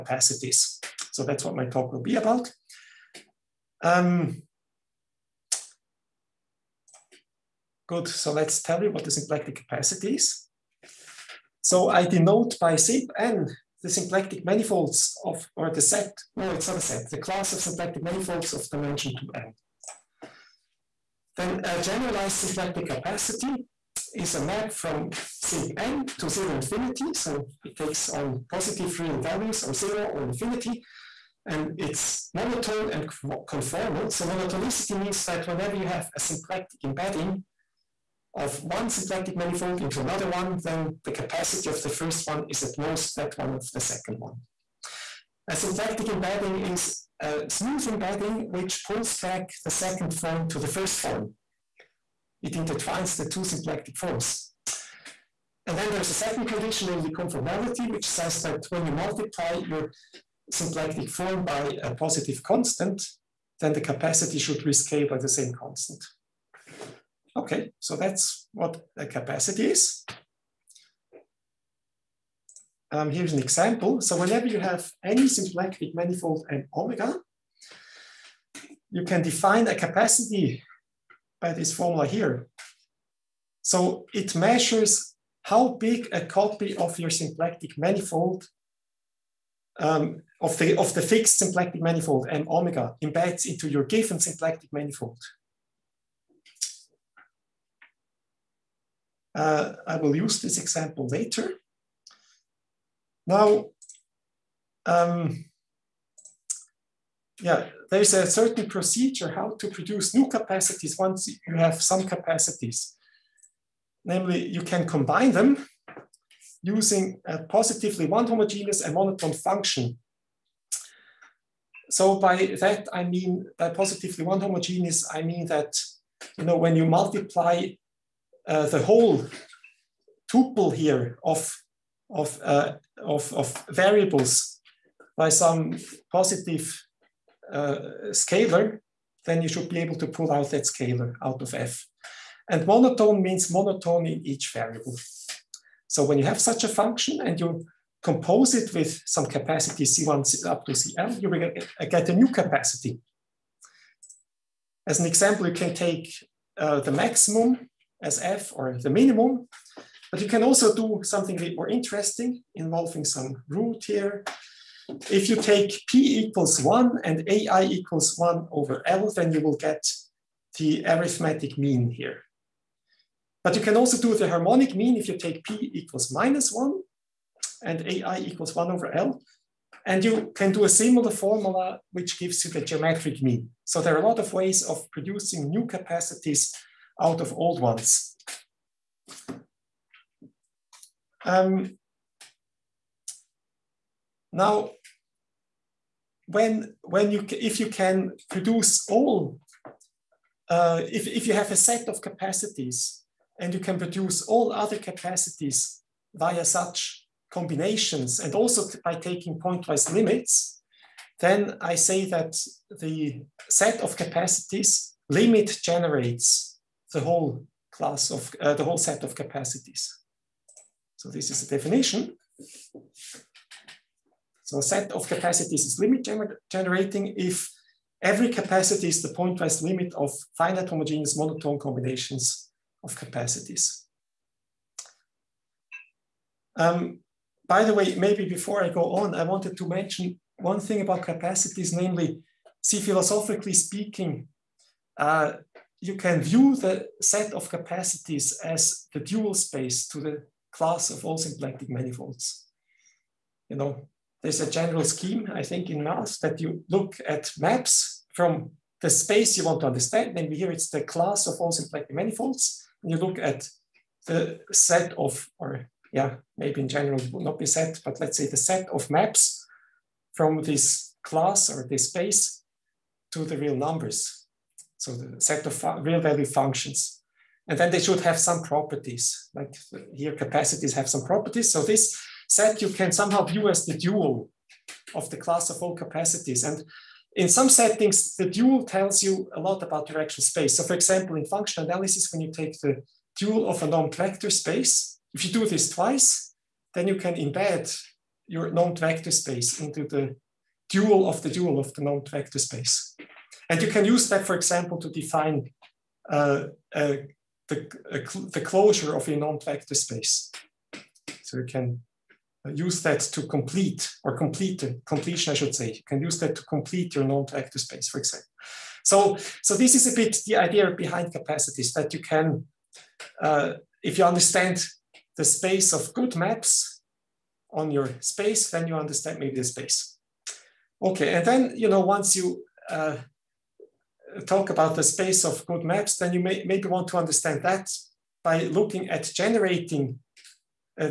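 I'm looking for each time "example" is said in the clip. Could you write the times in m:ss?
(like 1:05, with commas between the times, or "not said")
1:13, 1:40, 2:35, 4:50, 5:04, 5:17.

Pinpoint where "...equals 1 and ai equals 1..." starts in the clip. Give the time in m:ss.
2:46.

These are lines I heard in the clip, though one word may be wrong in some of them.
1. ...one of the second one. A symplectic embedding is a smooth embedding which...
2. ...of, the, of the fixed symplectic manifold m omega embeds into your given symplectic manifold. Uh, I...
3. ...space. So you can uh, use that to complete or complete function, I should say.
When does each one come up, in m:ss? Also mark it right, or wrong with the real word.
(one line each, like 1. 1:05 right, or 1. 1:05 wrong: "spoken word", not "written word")
1. 0:43 right
2. 1:30 right
3. 5:09 wrong: "completion", not "function".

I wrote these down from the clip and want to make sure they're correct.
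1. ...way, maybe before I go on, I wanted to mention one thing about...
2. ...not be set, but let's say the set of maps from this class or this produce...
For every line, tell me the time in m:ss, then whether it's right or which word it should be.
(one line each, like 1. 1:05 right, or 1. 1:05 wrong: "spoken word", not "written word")
1. 3:57 right
2. 4:27 wrong: "space", not "produce".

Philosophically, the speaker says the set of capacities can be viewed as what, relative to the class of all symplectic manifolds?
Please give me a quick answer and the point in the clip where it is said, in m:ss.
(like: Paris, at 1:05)
the dual space, at 4:08.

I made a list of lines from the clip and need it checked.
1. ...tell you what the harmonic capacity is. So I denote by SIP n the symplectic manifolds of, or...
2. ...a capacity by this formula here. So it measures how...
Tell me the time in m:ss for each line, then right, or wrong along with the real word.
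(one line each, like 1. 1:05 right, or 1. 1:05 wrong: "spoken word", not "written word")
1. 0:08 wrong: "symplectic", not "harmonic"
2. 1:19 right.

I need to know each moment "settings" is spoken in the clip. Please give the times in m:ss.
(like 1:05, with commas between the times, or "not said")
4:47.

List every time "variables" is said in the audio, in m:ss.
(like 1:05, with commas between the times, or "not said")
2:13, 2:24.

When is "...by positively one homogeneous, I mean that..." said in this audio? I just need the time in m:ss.
2:03.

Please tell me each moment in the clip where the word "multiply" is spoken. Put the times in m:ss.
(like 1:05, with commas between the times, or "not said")
0:58, 2:06.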